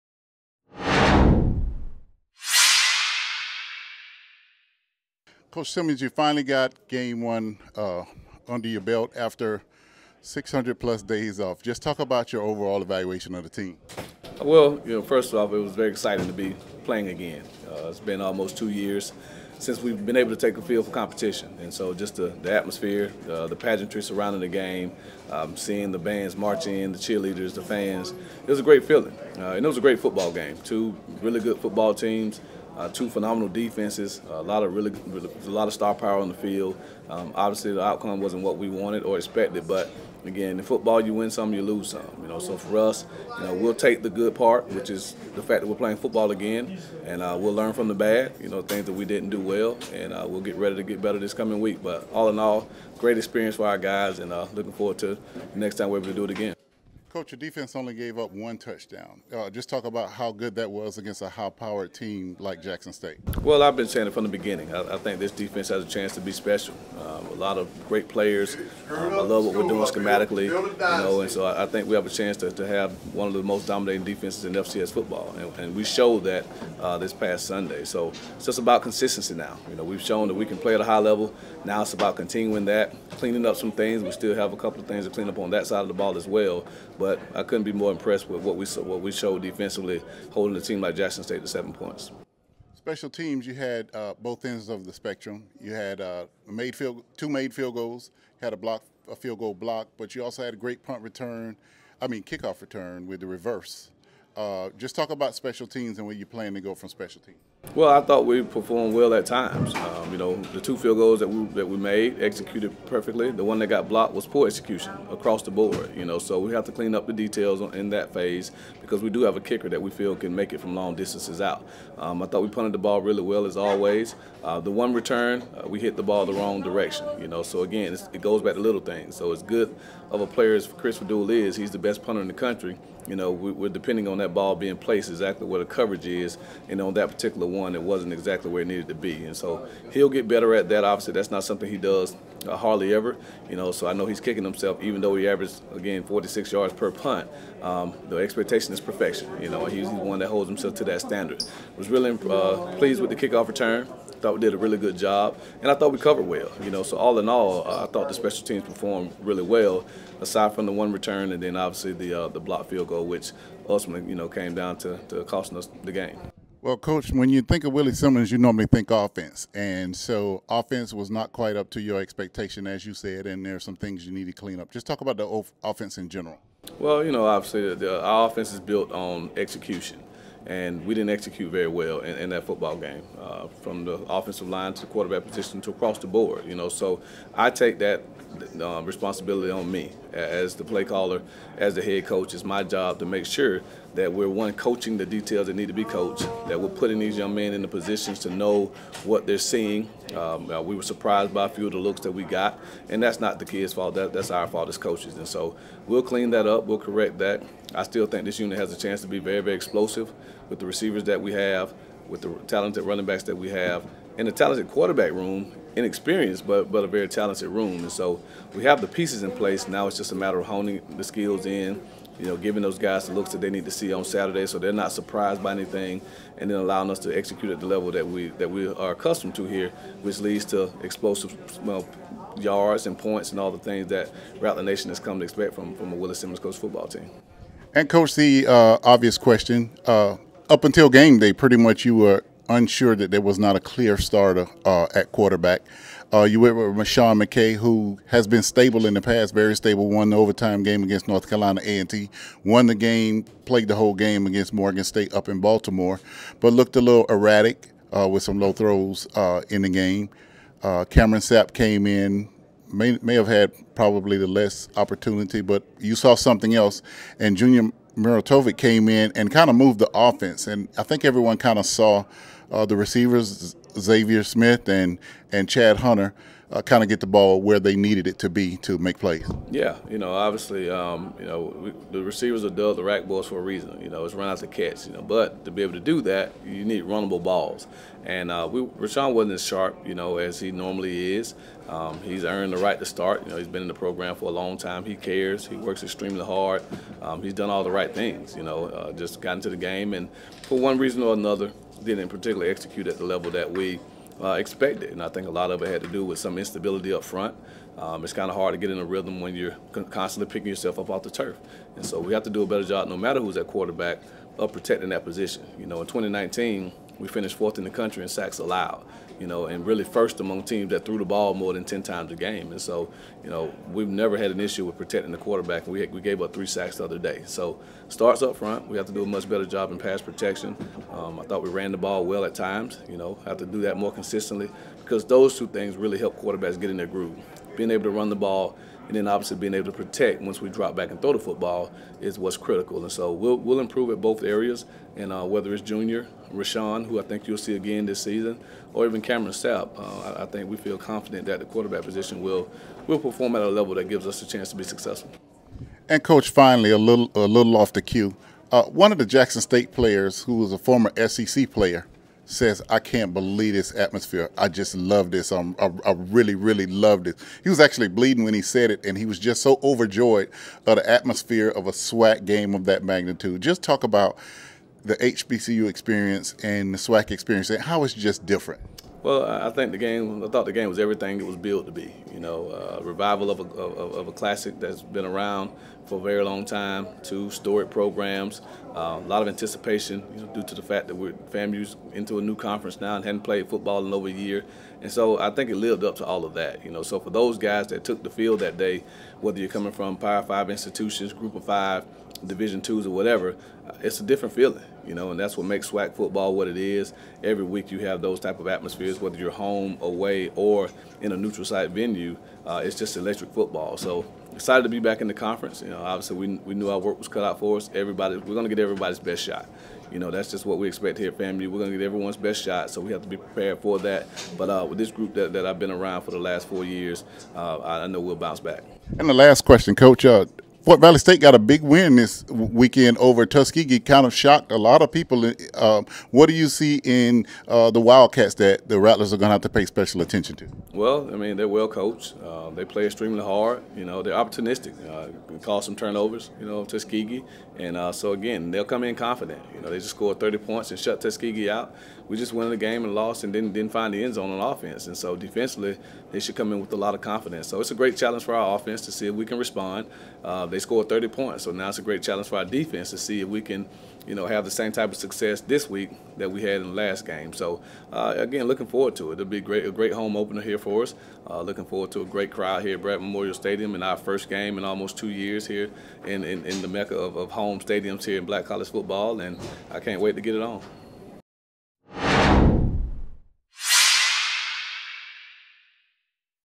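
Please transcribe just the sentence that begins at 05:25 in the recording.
We, had, we gave up three sacks the other day.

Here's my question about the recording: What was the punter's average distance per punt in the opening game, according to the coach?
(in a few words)
46 yards.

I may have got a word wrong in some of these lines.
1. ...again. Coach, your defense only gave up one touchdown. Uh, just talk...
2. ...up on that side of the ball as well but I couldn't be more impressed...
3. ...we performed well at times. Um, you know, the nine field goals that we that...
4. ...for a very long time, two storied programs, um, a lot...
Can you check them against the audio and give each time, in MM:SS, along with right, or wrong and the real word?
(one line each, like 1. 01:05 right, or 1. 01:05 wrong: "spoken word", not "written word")
1. 00:56 right
2. 01:25 right
3. 01:48 wrong: "two", not "nine"
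4. 06:25 right.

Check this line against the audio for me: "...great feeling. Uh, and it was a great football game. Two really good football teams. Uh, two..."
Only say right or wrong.
right.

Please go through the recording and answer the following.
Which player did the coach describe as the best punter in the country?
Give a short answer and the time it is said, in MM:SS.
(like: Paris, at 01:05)
Chris Faddoul, at 02:10.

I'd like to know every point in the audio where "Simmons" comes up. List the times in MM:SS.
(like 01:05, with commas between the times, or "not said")
00:05, 02:47, 03:56.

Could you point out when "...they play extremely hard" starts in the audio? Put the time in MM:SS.
07:22.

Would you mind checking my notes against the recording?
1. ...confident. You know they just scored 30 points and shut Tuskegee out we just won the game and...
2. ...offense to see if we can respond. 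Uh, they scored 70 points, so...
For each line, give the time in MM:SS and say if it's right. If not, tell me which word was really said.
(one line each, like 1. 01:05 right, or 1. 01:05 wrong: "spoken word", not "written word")
1. 07:28 right
2. 07:38 wrong: "30", not "70".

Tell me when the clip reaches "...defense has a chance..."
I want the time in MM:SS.
01:05.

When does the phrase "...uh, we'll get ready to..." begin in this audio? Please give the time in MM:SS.
00:50.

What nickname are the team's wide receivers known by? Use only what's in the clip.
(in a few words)
rack balls.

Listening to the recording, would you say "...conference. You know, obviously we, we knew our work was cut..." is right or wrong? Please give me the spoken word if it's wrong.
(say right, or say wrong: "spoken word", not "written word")
right.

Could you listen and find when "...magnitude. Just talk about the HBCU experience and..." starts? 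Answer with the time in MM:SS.
06:12.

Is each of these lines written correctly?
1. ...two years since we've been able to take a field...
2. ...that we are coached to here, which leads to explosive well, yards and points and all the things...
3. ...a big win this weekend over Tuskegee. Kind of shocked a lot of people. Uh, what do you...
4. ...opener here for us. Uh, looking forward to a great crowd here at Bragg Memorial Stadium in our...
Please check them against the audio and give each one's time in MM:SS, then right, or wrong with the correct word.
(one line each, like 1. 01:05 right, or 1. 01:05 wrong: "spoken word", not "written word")
1. 00:18 right
2. 03:48 wrong: "accustomed", not "coached"
3. 07:11 right
4. 07:50 right.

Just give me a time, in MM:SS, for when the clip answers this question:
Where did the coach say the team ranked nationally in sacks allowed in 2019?
05:17.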